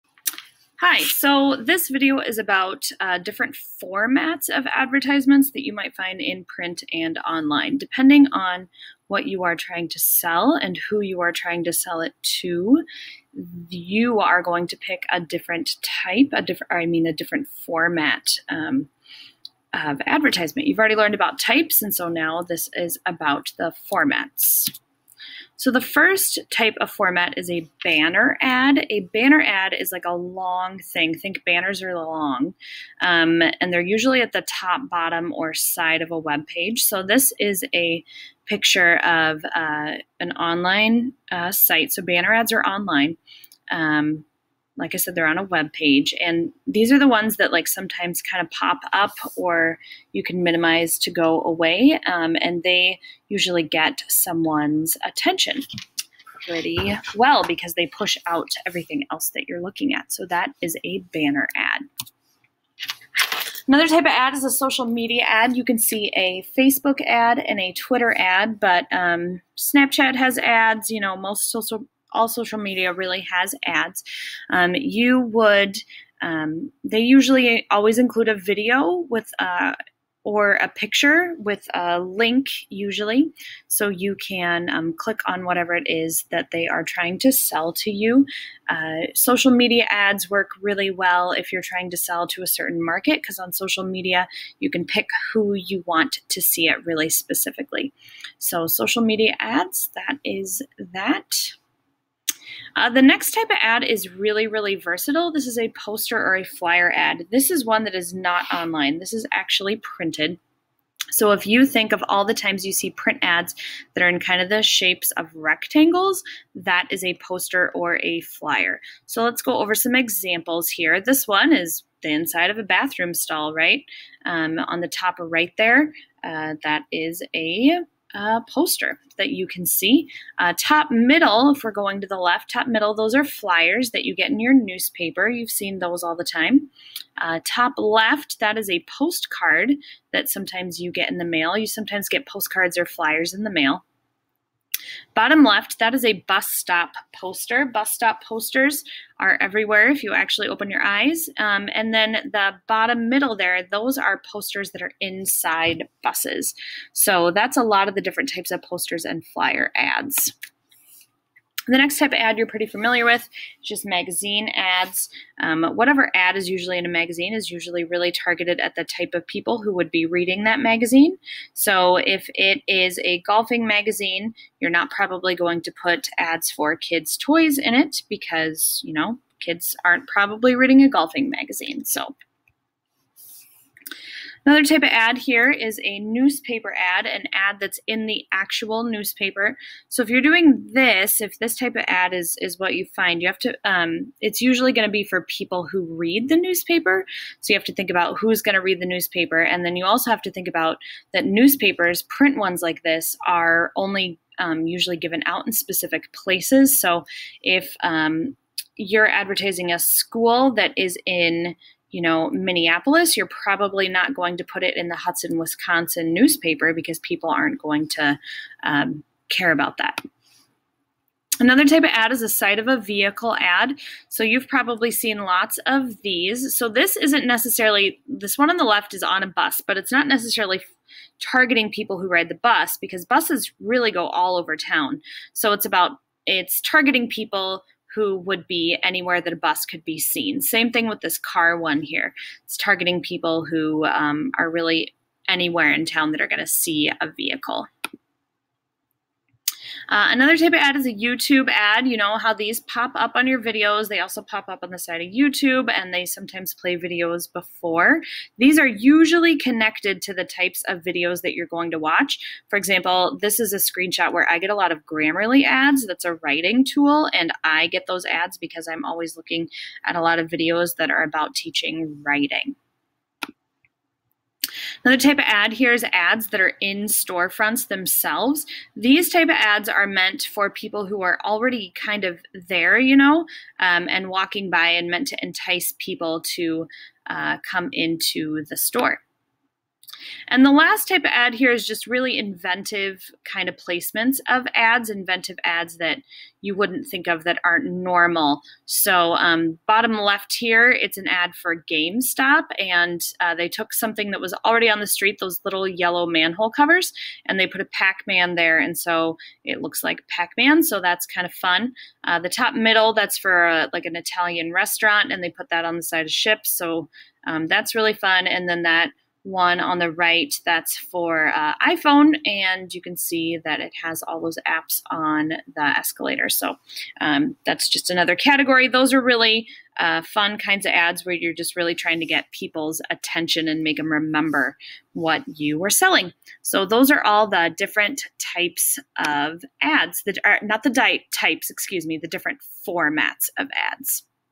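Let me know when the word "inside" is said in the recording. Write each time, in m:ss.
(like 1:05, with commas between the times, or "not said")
2:02, 2:34.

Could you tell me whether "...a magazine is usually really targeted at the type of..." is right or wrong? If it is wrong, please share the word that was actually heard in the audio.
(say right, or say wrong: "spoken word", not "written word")
right.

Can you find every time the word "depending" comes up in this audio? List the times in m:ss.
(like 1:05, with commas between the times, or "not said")
0:07.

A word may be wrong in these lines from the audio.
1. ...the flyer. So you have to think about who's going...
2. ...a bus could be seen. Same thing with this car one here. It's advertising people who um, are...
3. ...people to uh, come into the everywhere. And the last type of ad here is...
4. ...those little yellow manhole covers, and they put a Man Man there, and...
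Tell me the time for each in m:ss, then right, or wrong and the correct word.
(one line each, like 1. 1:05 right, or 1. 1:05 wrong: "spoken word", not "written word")
1. 3:16 wrong: "newspaper", not "flyer"
2. 3:59 wrong: "targeting", not "advertising"
3. 4:45 wrong: "store", not "everywhere"
4. 5:05 wrong: "Pac", not "Man".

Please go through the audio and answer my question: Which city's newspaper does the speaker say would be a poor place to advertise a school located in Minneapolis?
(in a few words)
Hudson, Wisconsin.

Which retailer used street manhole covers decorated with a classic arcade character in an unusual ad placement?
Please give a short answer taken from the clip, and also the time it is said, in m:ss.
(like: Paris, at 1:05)
GameStop, at 5:01.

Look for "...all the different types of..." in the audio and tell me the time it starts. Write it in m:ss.
5:37.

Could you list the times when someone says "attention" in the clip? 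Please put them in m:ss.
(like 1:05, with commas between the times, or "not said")
0:55, 5:32.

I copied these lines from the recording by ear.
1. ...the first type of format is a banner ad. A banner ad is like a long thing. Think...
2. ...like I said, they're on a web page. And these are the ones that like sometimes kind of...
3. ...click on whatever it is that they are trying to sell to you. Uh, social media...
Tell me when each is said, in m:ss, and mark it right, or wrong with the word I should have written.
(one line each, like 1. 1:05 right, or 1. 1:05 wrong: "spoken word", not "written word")
1. 0:25 right
2. 0:44 right
3. 1:24 right.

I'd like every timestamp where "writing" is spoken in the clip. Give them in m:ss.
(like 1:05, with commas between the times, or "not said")
4:26, 4:32.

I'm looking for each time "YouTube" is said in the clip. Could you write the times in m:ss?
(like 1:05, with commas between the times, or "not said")
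4:10, 4:15.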